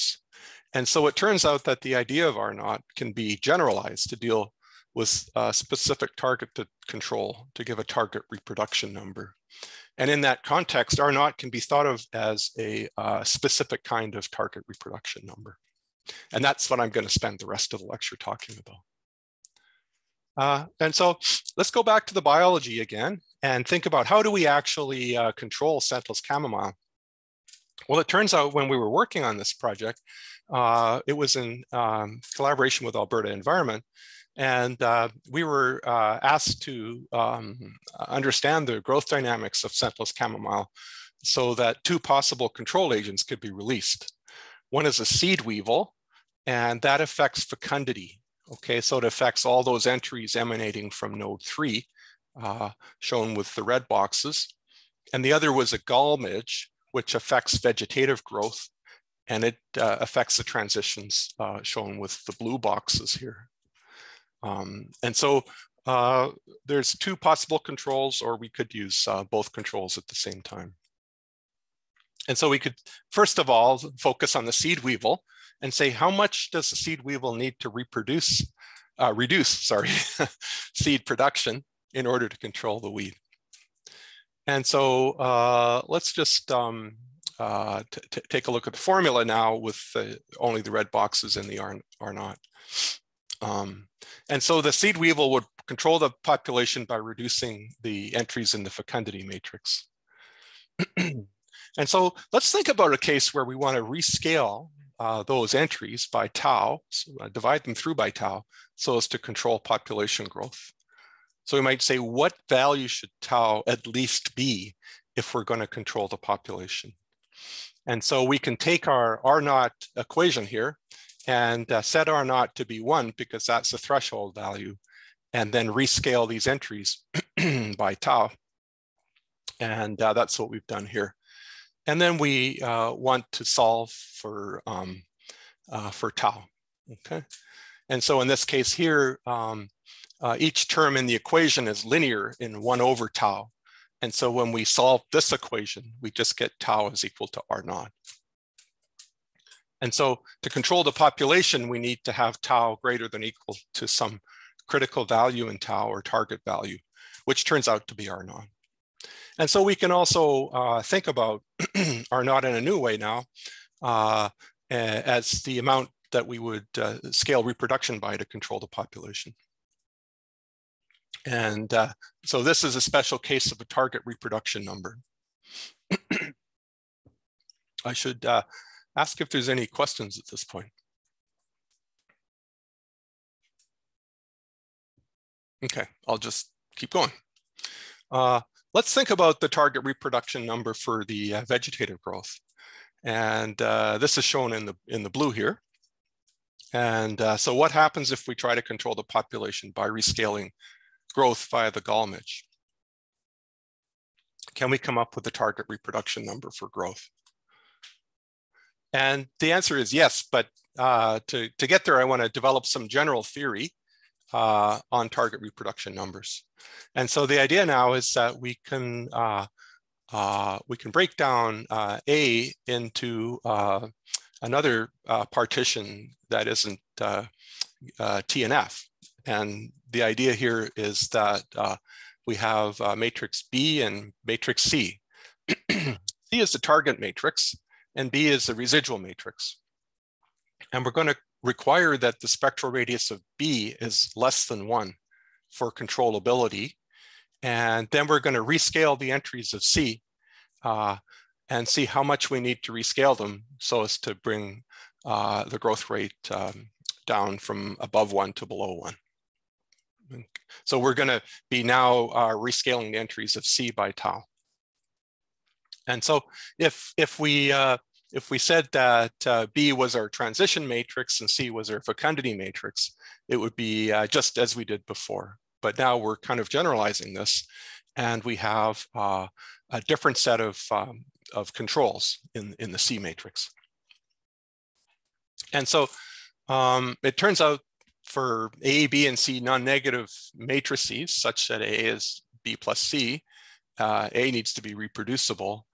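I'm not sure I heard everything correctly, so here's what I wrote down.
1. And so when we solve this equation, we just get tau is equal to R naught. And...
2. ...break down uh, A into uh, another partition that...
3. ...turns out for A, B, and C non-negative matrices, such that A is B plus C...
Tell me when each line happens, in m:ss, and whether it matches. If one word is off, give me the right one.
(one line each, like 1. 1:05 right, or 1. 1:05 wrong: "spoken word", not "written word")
1. 2:24 right
2. 3:40 right
3. 4:47 right.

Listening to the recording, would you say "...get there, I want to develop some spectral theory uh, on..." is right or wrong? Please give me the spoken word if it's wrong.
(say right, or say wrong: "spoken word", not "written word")
wrong: "general", not "spectral".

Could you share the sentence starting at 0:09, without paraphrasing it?
And in that context, R naught can be thought of as a uh, specific kind of target reproduction number.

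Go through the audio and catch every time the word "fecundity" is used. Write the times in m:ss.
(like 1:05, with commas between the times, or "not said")
0:47, 1:38, 4:31.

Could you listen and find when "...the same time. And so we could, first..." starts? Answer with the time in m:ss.
1:10.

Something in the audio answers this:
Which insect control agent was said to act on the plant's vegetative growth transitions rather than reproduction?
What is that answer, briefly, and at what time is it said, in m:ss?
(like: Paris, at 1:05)
gall midge, at 0:55.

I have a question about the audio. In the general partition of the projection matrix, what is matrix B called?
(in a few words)
residual matrix.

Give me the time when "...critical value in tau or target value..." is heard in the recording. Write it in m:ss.
2:34.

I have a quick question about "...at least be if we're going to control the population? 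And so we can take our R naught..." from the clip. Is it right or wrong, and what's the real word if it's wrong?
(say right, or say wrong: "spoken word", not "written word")
right.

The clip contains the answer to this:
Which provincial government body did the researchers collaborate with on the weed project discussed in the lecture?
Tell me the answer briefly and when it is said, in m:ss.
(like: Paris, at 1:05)
Alberta Environment, at 0:32.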